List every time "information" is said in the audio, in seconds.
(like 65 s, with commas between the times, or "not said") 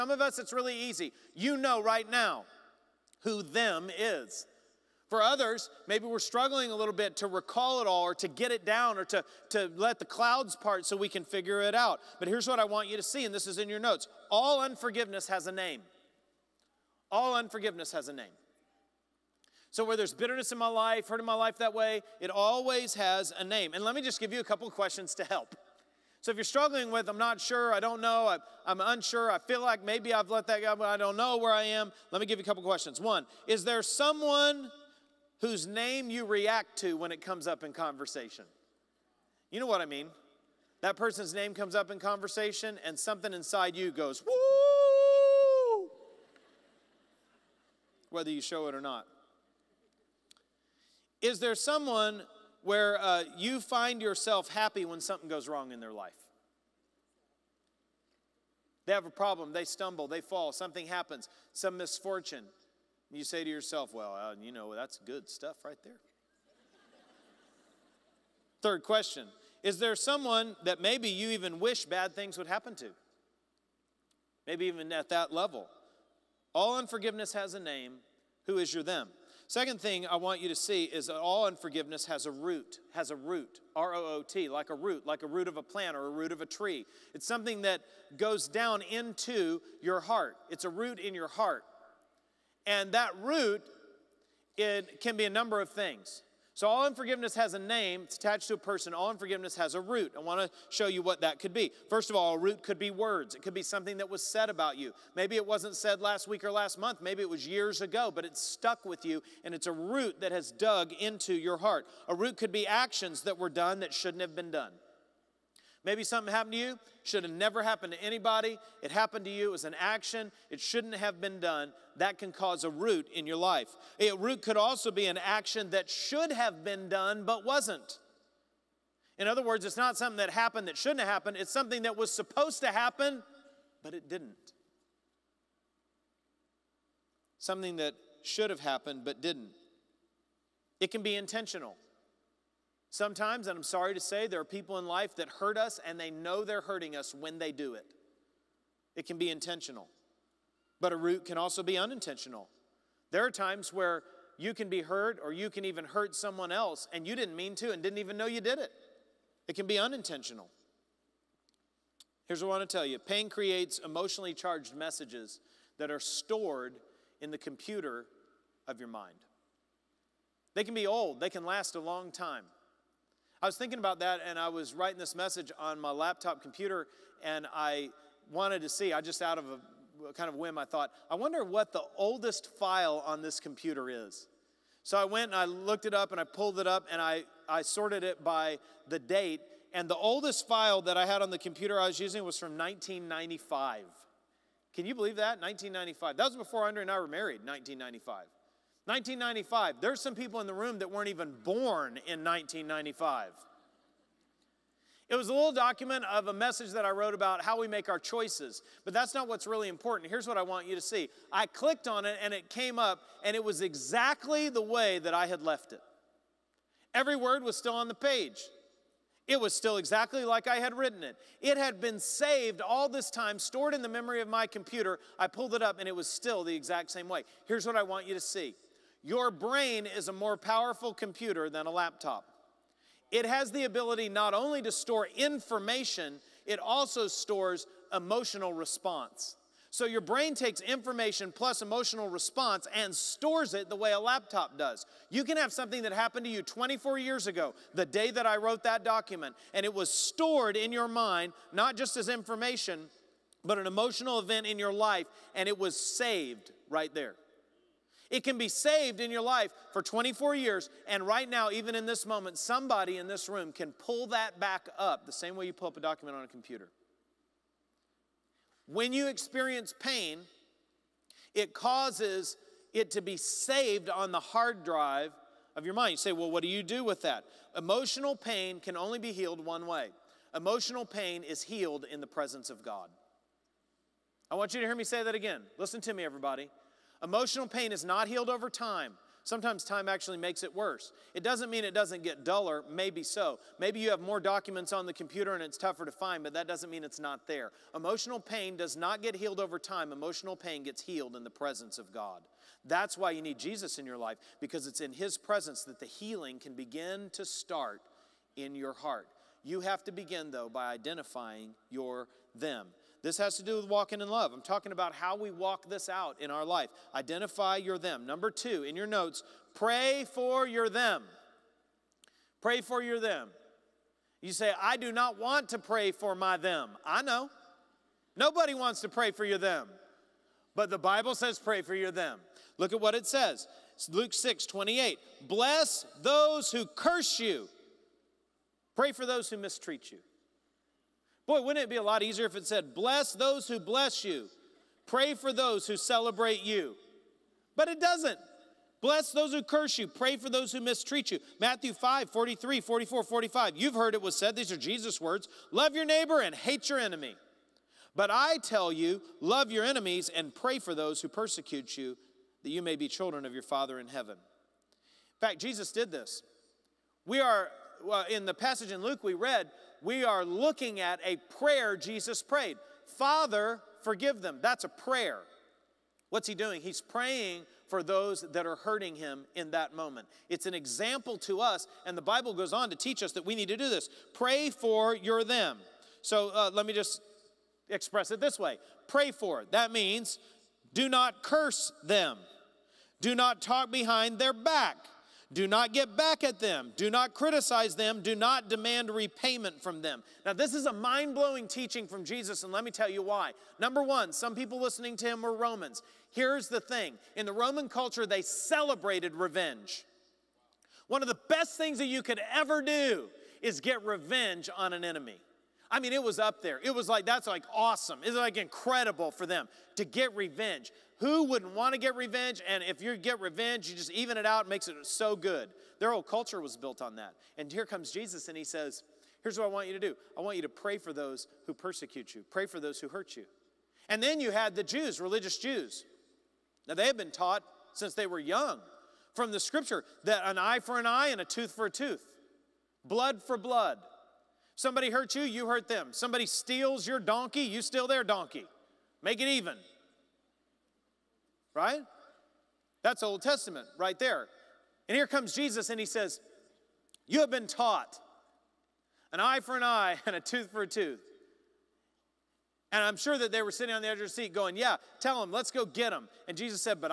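235 s, 240 s, 252 s.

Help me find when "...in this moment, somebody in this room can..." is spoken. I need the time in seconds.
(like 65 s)
261 s.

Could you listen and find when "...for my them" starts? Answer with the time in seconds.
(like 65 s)
325 s.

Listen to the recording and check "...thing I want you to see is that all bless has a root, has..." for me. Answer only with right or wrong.
wrong.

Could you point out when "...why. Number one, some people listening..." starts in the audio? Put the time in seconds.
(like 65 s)
403 s.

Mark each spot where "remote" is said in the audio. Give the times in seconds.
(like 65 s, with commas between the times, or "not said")
not said.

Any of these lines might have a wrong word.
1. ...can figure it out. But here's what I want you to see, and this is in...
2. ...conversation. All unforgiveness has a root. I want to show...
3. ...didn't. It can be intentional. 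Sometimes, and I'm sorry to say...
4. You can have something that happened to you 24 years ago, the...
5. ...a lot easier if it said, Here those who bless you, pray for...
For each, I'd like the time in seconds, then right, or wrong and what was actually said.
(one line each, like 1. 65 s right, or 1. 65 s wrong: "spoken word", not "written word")
1. 11 s right
2. 98 s wrong: "person", not "conversation"
3. 139 s right
4. 245 s right
5. 341 s wrong: "Bless", not "Here".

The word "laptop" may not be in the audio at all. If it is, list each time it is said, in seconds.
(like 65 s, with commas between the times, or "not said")
175 s, 231 s, 243 s.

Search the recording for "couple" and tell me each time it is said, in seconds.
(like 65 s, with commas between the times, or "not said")
24 s, 32 s.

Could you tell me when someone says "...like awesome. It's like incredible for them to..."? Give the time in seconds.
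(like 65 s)
417 s.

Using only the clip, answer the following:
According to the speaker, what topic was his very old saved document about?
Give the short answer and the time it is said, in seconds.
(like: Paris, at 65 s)
how we make our choices, at 207 s.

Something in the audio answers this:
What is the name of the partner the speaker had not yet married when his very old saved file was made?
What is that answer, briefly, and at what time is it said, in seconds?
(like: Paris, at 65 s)
Andrea, at 196 s.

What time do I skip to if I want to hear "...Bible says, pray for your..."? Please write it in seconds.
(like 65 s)
330 s.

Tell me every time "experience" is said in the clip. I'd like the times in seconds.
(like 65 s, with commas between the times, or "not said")
269 s.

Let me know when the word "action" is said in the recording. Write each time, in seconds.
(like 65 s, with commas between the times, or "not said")
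112 s, 119 s, 125 s.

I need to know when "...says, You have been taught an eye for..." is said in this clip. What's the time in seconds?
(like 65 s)
455 s.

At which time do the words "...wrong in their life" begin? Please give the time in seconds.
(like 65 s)
55 s.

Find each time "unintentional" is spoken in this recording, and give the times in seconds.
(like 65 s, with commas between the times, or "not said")
151 s, 159 s.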